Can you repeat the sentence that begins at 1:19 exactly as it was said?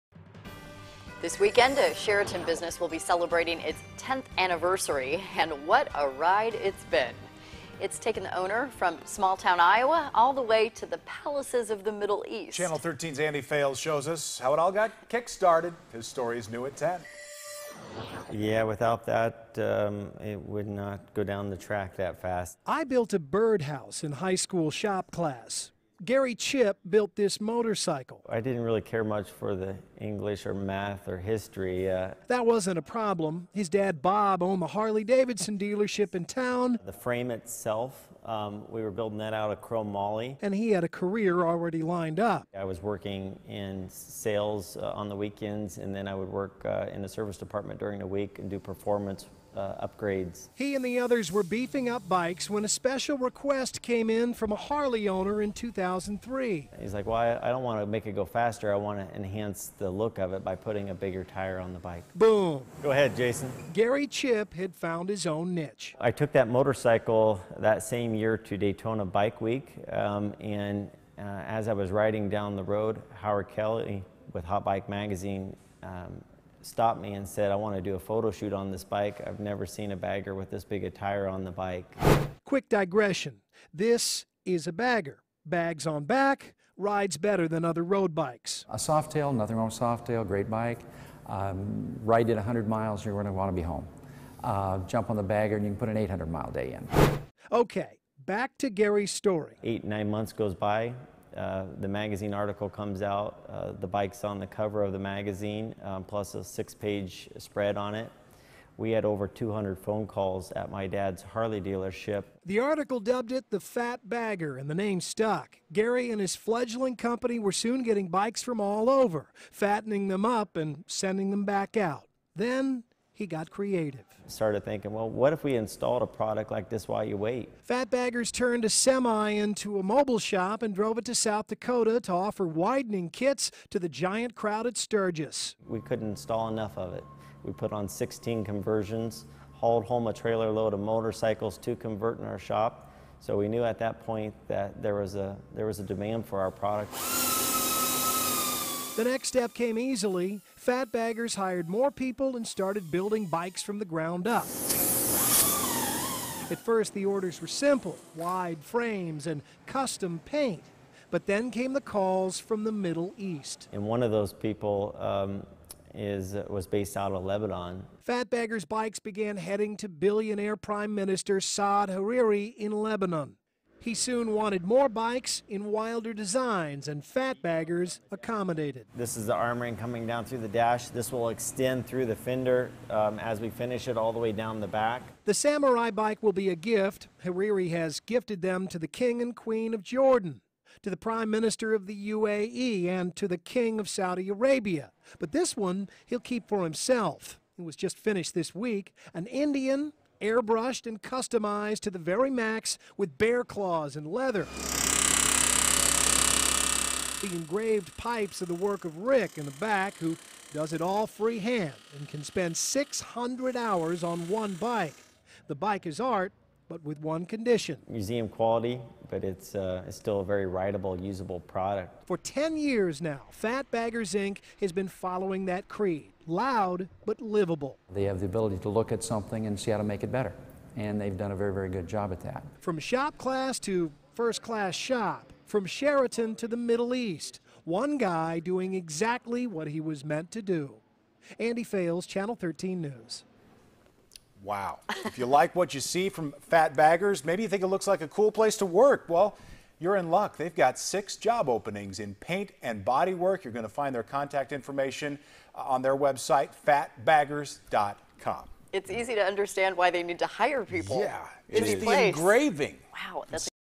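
I've never seen a bagger with this big a tire on the bike.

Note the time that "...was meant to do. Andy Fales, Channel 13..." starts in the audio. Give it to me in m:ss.
3:59.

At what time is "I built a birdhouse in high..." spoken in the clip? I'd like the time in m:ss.
0:22.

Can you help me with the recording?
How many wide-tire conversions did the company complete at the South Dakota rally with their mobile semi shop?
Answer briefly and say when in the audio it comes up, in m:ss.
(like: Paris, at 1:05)
16, at 2:17.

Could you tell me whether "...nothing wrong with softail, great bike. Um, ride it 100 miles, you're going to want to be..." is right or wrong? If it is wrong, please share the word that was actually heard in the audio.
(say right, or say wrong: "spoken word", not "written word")
right.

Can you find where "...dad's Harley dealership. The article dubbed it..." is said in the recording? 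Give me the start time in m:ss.
1:50.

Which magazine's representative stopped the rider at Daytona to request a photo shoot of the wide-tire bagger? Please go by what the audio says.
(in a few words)
Hot Bike Magazine.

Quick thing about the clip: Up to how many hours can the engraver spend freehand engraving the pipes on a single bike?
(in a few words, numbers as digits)
600.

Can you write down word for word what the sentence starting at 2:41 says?
But then came the calls from the Middle East.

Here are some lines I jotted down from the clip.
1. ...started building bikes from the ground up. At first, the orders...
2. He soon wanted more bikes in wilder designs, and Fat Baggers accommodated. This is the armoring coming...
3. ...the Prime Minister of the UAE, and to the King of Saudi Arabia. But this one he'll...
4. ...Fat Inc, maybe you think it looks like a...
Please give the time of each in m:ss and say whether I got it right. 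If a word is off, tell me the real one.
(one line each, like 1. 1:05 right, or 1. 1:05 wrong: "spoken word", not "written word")
1. 2:32 right
2. 2:53 right
3. 3:10 right
4. 4:06 wrong: "Baggers", not "Inc".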